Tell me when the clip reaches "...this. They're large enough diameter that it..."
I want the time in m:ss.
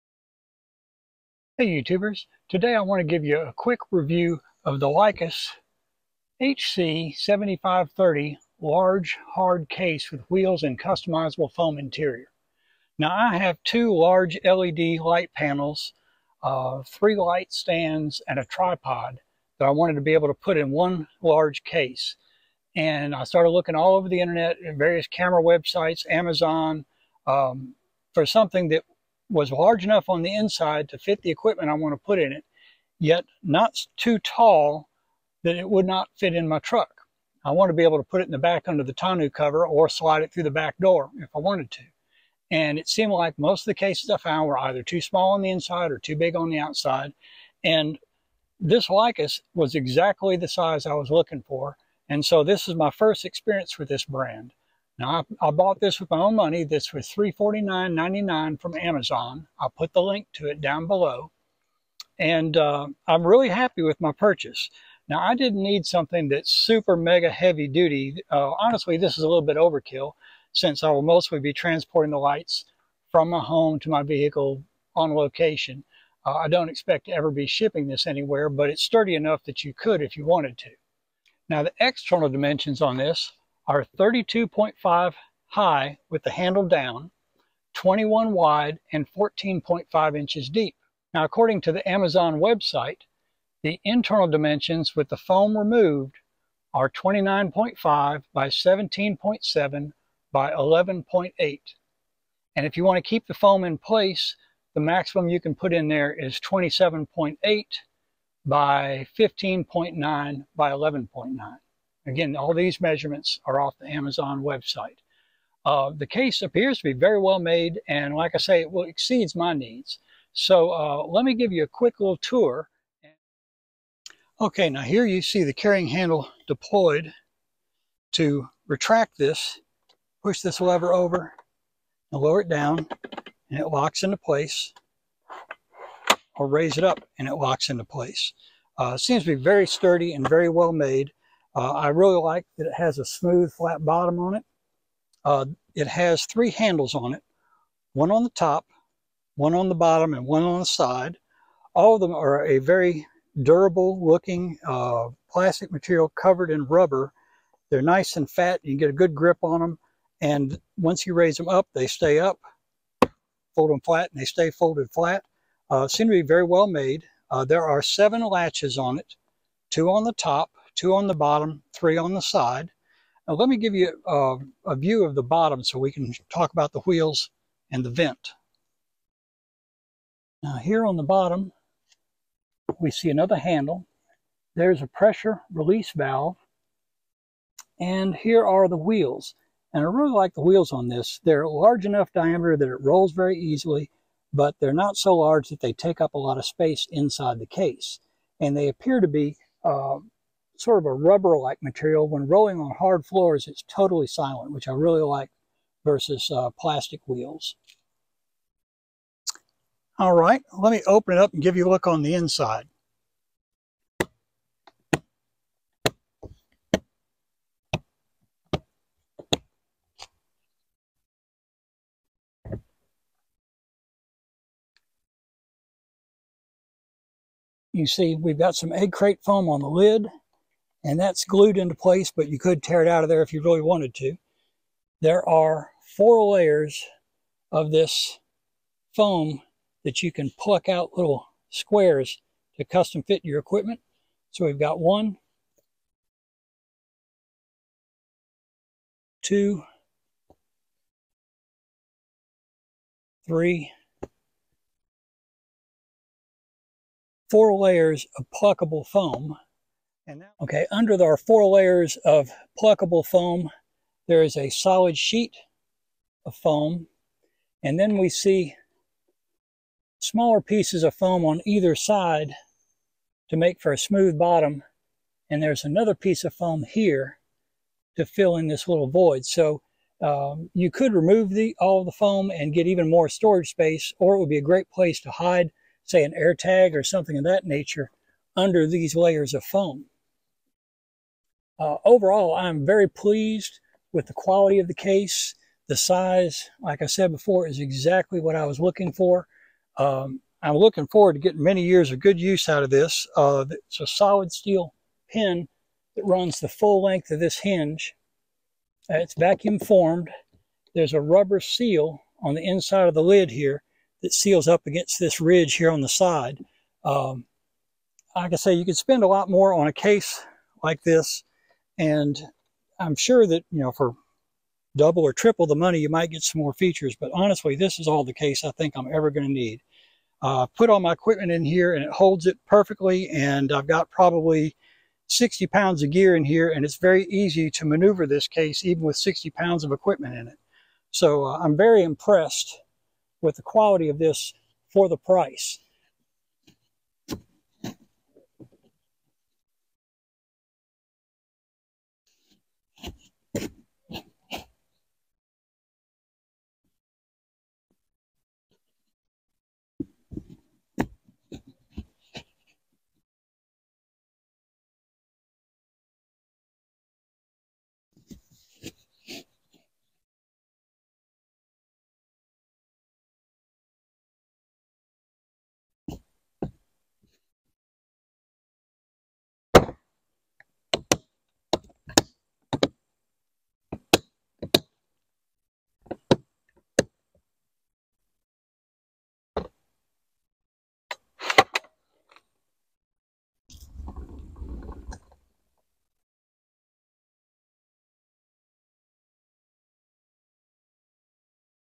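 3:10.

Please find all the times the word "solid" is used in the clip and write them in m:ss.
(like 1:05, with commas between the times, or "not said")
4:24, 5:03.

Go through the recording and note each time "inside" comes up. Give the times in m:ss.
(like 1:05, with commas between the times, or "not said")
0:30, 0:45, 3:16, 3:32, 5:12.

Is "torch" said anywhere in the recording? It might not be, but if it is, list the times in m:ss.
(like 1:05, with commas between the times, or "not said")
not said.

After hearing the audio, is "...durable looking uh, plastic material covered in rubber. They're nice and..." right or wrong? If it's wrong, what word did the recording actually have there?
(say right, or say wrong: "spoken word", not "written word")
right.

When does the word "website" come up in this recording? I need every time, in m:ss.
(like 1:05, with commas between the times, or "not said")
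0:25, 1:32, 1:54.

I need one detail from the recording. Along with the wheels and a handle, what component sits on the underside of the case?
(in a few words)
pressure release valve.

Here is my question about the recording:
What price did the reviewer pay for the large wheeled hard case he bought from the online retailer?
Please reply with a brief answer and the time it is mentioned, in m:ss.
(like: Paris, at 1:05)
$349.99, at 0:57.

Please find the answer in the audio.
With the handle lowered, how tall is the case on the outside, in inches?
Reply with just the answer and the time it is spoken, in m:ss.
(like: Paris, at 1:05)
32.5, at 1:23.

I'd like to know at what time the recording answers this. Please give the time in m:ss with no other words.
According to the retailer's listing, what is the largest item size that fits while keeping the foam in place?
1:46.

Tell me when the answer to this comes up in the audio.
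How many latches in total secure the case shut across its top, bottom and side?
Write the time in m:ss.
2:47.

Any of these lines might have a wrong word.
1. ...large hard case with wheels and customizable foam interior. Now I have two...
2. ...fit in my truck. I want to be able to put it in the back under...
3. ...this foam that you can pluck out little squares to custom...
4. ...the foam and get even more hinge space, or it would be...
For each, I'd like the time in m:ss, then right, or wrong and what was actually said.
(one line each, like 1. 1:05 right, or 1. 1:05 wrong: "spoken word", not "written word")
1. 0:08 right
2. 0:36 right
3. 3:57 right
4. 4:41 wrong: "storage", not "hinge".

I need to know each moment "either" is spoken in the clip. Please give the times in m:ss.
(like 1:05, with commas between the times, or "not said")
0:44, 4:31.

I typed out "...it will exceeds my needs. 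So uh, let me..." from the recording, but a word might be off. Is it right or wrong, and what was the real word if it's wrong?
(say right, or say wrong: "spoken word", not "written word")
right.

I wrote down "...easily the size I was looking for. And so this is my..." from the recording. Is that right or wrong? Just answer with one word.
wrong.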